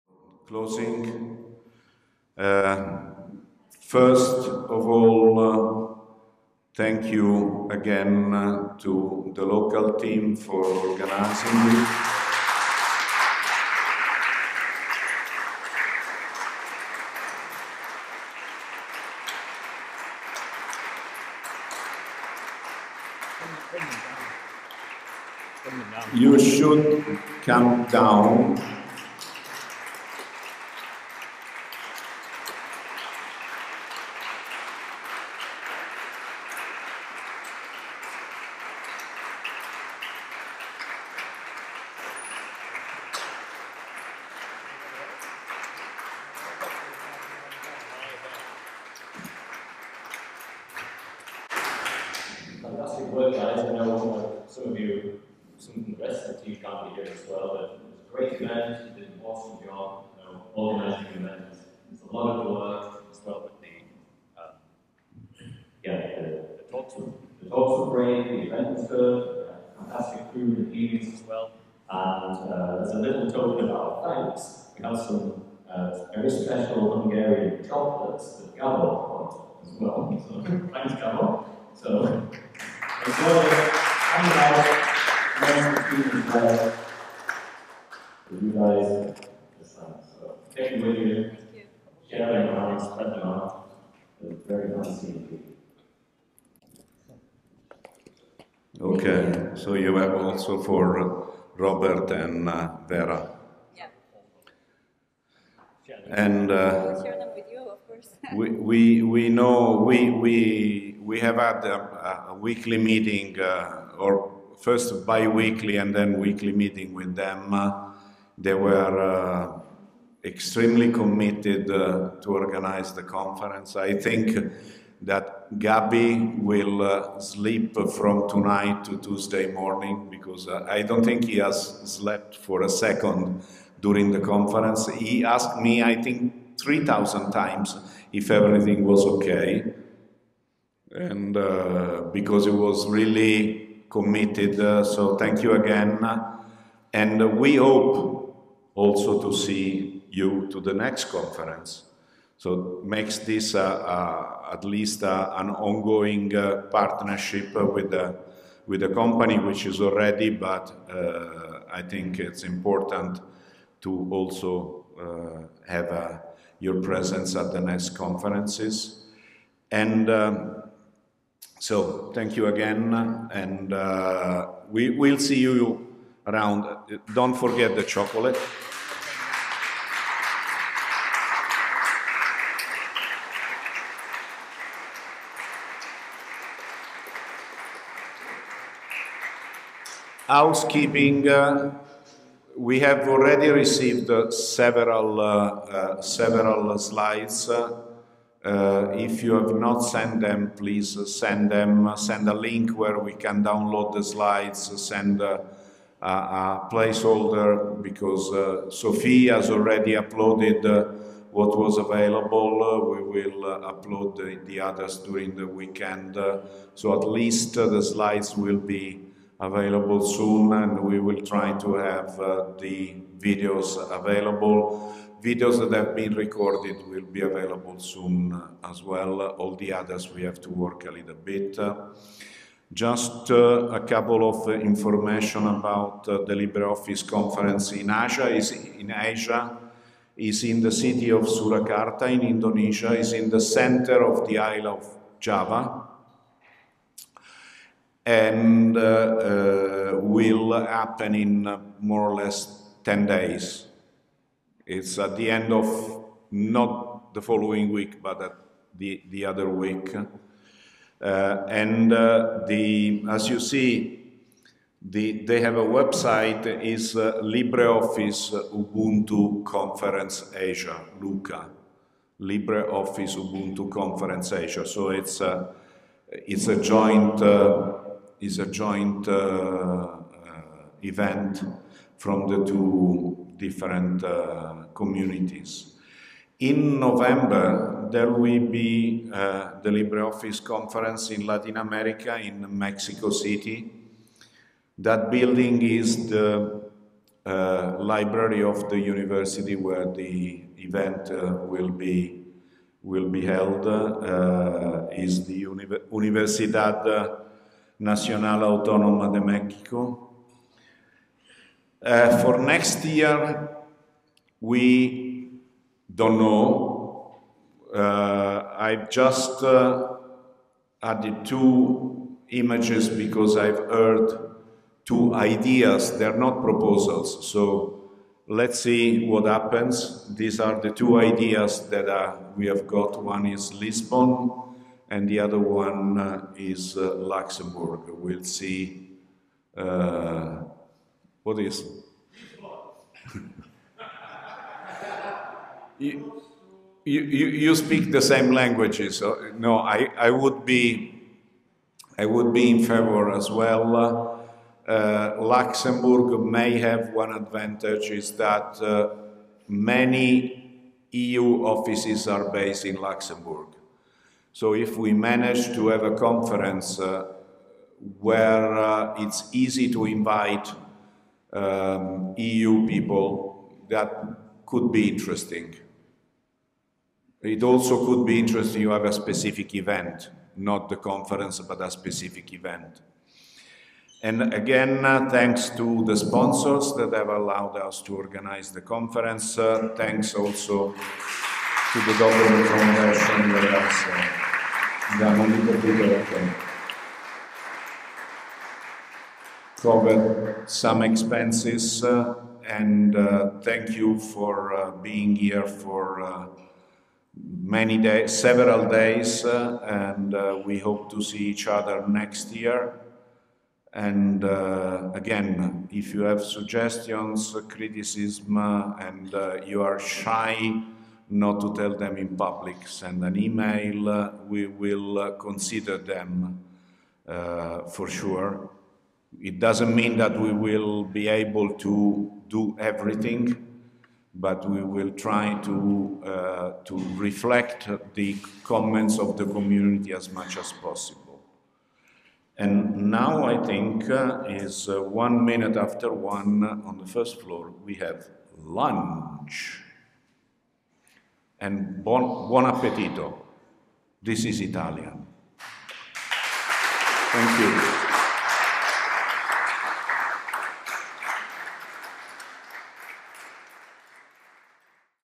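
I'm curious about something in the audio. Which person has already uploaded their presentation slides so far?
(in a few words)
Sophie.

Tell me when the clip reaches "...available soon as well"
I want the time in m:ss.
3:47.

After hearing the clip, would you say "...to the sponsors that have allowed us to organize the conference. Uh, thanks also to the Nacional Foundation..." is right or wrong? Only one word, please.
wrong.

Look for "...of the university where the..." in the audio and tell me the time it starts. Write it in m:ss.
4:58.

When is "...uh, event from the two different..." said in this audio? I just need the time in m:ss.
4:39.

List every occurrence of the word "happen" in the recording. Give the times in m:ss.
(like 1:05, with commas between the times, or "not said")
4:10, 5:29.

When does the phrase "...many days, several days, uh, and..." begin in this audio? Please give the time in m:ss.
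6:47.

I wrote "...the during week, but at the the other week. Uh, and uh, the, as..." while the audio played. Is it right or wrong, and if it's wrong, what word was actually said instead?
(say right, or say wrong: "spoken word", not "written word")
wrong: "following", not "during".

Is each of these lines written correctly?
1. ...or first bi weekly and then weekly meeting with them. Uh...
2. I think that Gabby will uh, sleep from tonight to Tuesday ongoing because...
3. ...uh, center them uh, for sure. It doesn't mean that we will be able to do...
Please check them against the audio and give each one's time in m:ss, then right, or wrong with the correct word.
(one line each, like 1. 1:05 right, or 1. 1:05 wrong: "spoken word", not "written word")
1. 1:53 right
2. 2:03 wrong: "morning", not "ongoing"
3. 7:04 wrong: "consider", not "center".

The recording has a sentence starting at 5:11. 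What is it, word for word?
Uh, for next year, we don't know.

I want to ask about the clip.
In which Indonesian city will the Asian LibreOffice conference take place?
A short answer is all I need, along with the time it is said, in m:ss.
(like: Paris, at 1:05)
Surakarta, at 4:01.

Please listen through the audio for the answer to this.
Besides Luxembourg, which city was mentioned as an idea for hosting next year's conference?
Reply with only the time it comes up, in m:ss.
5:33.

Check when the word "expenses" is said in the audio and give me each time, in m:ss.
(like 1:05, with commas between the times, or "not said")
6:40.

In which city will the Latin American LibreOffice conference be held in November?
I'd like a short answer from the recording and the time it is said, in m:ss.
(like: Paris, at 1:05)
Mexico City, at 4:52.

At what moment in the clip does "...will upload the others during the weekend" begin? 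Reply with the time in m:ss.
3:33.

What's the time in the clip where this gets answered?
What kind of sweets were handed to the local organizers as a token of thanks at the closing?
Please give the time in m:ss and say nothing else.
1:17.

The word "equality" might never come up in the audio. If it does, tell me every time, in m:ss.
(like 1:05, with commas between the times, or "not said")
not said.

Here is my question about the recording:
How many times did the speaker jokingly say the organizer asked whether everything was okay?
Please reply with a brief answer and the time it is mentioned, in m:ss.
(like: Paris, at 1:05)
3,000, at 2:16.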